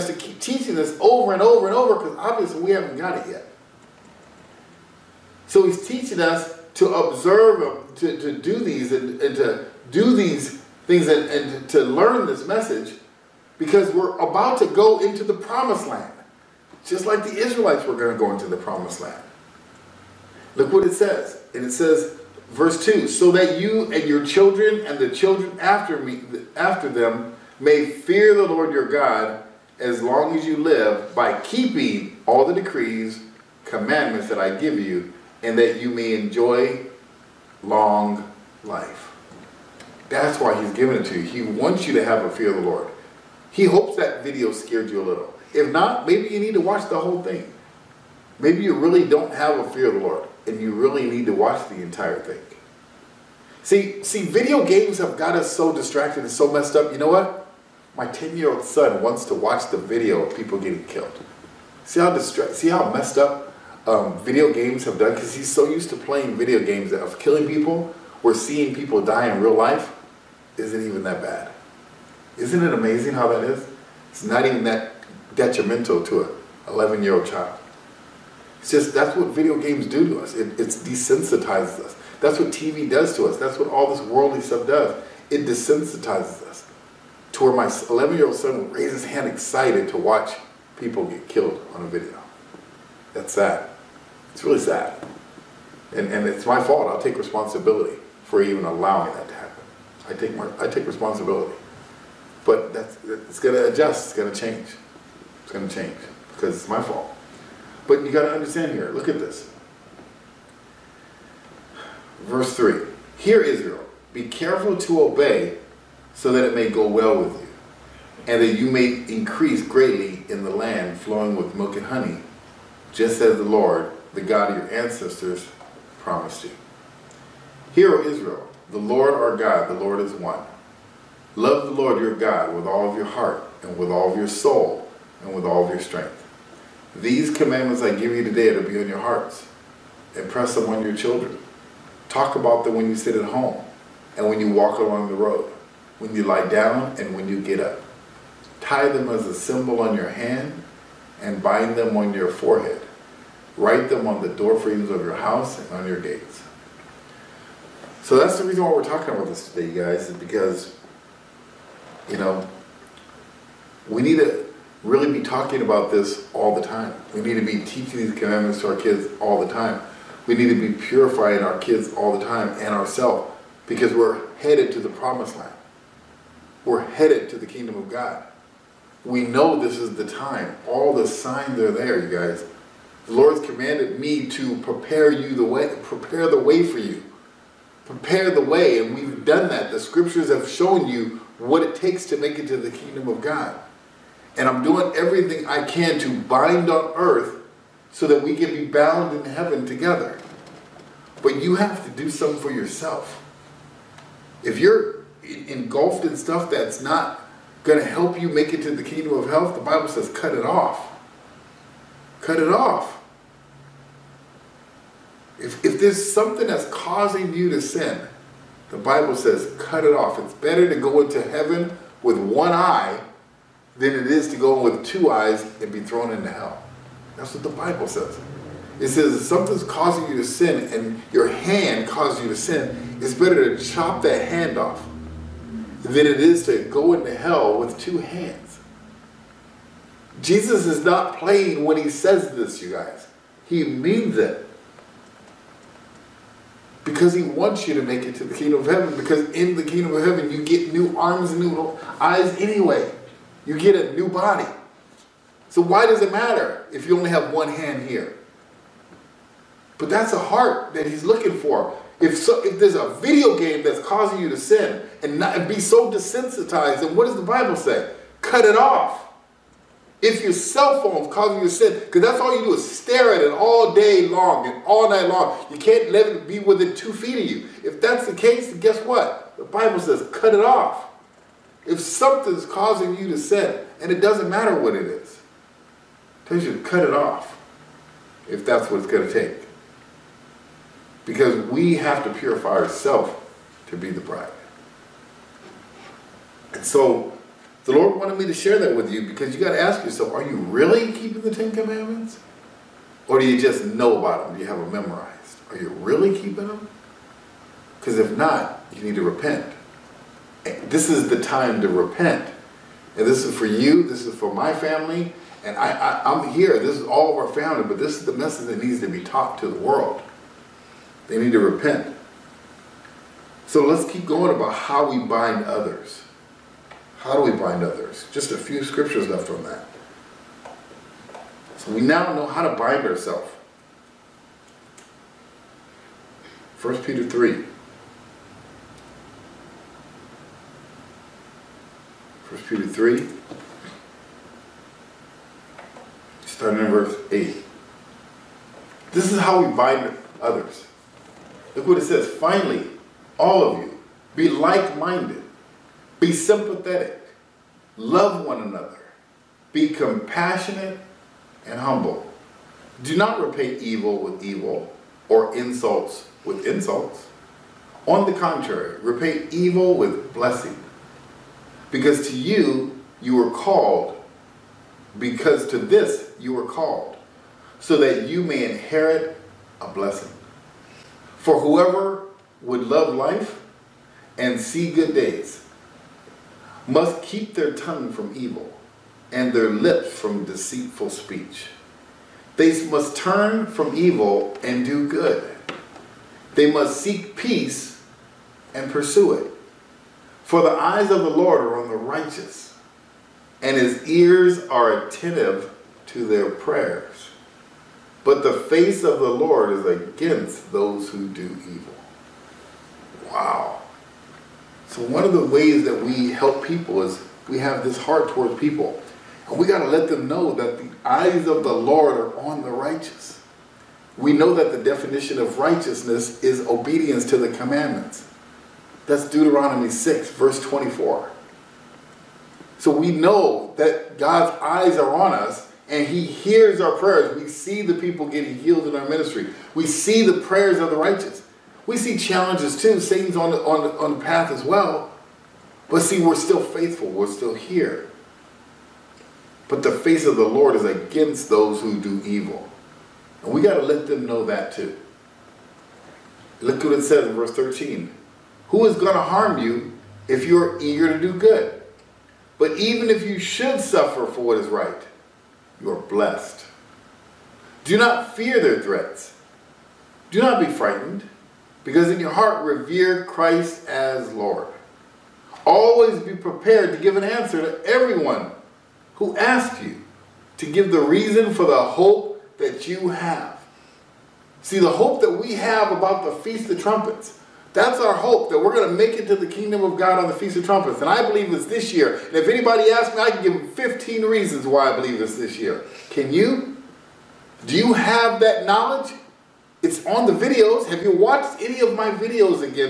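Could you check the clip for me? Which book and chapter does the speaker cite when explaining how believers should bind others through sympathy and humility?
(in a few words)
1 Peter 3.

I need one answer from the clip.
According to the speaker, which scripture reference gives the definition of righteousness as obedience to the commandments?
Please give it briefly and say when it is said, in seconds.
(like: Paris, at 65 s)
Deuteronomy 6:24, at 429 s.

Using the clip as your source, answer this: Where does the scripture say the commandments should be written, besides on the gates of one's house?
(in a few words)
door frames.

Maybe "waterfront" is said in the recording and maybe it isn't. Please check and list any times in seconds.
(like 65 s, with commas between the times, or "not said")
not said.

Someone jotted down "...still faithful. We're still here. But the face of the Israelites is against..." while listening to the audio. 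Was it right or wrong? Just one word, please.
wrong.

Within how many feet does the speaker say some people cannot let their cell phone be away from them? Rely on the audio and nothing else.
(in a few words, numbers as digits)
2.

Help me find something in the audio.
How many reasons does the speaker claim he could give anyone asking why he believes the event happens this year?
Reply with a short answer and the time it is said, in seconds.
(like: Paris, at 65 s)
15, at 493 s.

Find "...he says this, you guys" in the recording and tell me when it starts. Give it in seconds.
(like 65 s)
241 s.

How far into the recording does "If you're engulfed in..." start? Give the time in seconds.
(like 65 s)
204 s.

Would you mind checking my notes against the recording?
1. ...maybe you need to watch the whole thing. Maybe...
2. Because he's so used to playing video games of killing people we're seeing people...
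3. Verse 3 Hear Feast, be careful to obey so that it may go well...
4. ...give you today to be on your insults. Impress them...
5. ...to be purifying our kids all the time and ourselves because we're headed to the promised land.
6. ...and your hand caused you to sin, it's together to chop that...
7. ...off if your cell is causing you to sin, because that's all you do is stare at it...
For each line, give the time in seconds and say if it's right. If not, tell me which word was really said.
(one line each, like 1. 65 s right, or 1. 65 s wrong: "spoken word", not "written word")
1. 46 s right
2. 65 s right
3. 112 s wrong: "Israel", not "Feast"
4. 137 s wrong: "hearts", not "insults"
5. 170 s right
6. 230 s wrong: "better", not "together"
7. 268 s right.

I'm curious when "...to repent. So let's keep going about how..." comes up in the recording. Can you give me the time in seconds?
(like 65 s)
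321 s.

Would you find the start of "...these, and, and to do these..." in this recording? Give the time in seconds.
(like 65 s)
8 s.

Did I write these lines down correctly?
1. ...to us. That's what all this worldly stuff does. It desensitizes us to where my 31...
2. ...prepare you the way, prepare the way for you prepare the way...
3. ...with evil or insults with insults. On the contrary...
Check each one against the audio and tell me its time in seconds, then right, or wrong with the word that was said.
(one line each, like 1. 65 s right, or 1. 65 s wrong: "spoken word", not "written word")
1. 83 s wrong: "11", not "31"
2. 184 s right
3. 364 s right.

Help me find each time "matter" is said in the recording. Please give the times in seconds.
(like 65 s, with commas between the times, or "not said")
256 s, 284 s.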